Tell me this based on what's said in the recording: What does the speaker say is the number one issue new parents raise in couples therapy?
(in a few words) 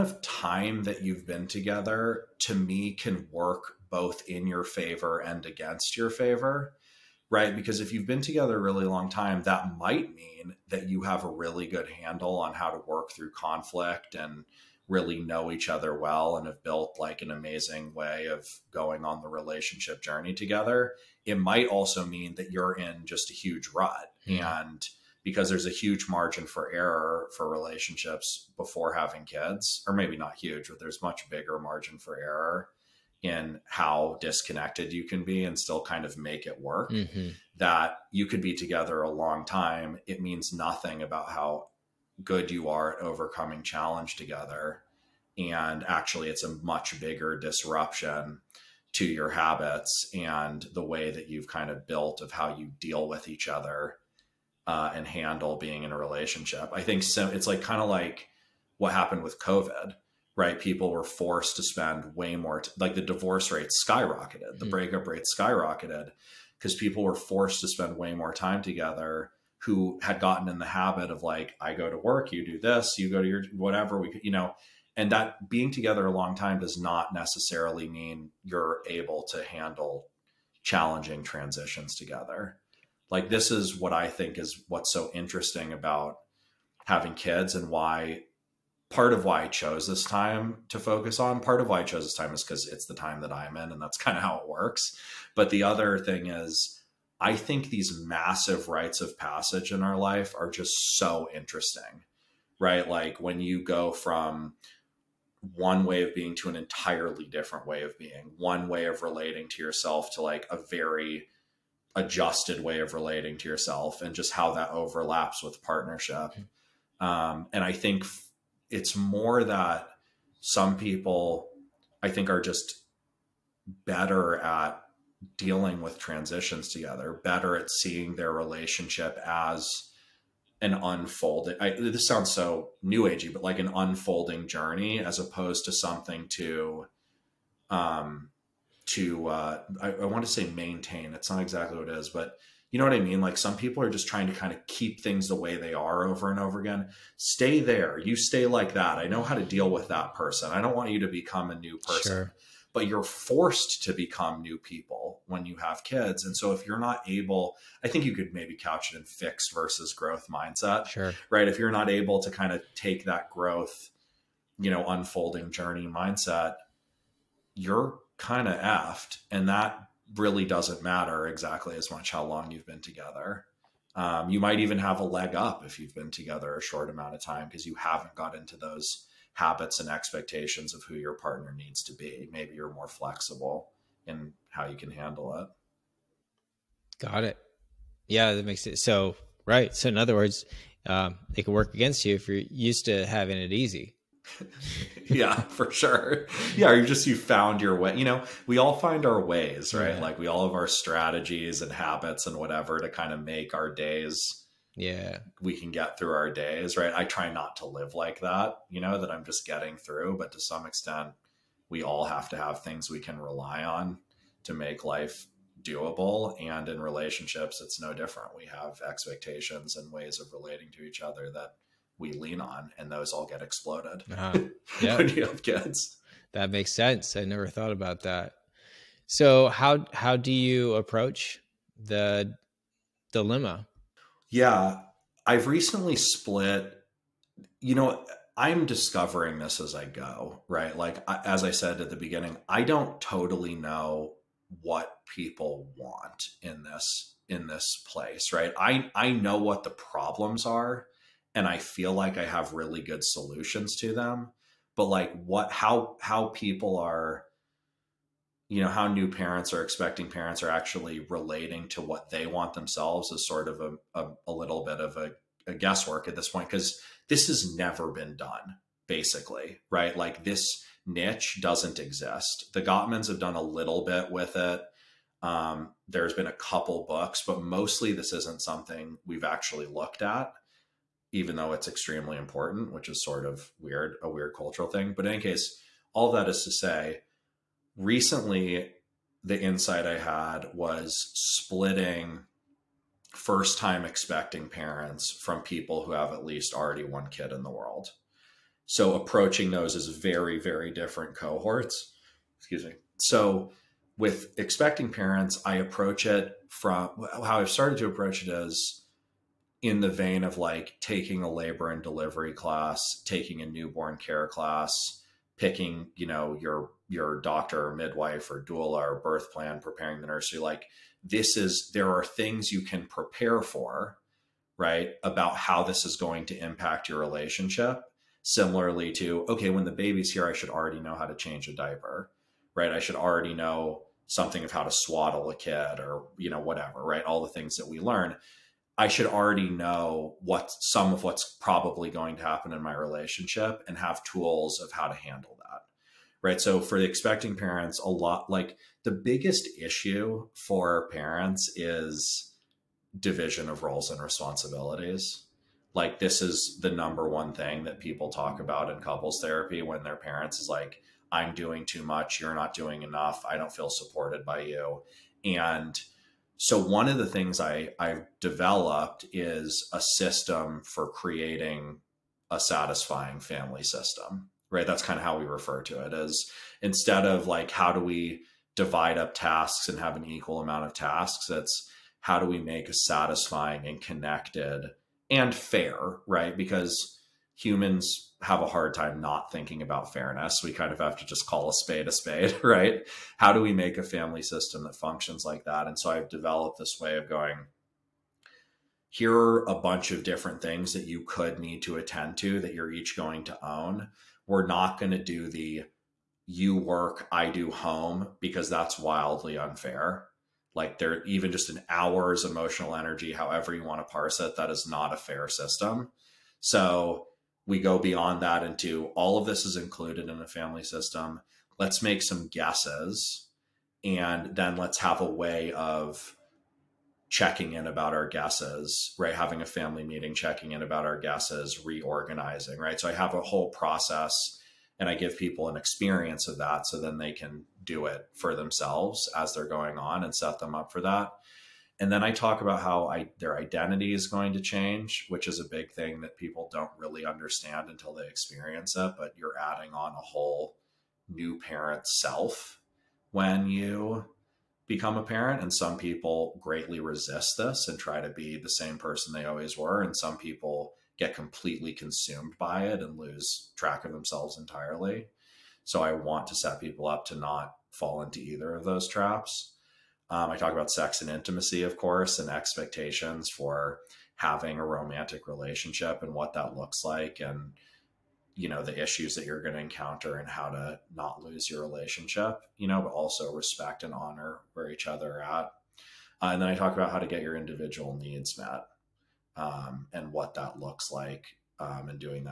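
division of roles and responsibilities.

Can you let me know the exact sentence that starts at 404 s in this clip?
We're not going to do the you work, I do home because that's wildly unfair.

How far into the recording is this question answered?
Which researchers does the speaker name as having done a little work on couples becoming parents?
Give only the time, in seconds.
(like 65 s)
272 s.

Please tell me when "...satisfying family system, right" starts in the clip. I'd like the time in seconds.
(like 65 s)
372 s.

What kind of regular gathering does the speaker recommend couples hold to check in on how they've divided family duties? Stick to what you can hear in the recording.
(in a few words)
a family meeting.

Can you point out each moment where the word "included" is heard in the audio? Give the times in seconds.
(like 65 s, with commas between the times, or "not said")
419 s.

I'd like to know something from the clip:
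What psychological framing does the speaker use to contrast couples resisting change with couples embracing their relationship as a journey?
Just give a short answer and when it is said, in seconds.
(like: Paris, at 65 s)
fixed versus growth mindset, at 159 s.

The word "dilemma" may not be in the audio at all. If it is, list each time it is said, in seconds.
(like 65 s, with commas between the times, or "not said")
233 s.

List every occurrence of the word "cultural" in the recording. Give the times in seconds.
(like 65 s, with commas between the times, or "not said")
284 s.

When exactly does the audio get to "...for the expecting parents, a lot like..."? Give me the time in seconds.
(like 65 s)
346 s.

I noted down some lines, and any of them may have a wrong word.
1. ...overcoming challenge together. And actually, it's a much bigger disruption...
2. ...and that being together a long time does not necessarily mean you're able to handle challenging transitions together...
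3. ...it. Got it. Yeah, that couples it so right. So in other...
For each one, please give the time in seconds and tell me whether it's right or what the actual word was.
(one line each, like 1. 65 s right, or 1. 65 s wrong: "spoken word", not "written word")
1. 43 s right
2. 74 s right
3. 185 s wrong: "makes", not "couples".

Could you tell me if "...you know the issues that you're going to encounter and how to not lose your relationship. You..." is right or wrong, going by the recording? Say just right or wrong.
right.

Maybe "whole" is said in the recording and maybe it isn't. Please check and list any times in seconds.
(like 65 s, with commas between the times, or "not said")
433 s, 450 s.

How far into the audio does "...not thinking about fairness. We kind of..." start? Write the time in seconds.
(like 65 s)
388 s.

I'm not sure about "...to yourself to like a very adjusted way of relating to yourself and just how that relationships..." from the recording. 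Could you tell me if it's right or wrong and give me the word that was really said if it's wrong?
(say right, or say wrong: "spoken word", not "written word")
wrong: "overlaps", not "relationships".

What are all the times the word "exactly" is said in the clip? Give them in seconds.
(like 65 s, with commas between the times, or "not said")
141 s, 171 s.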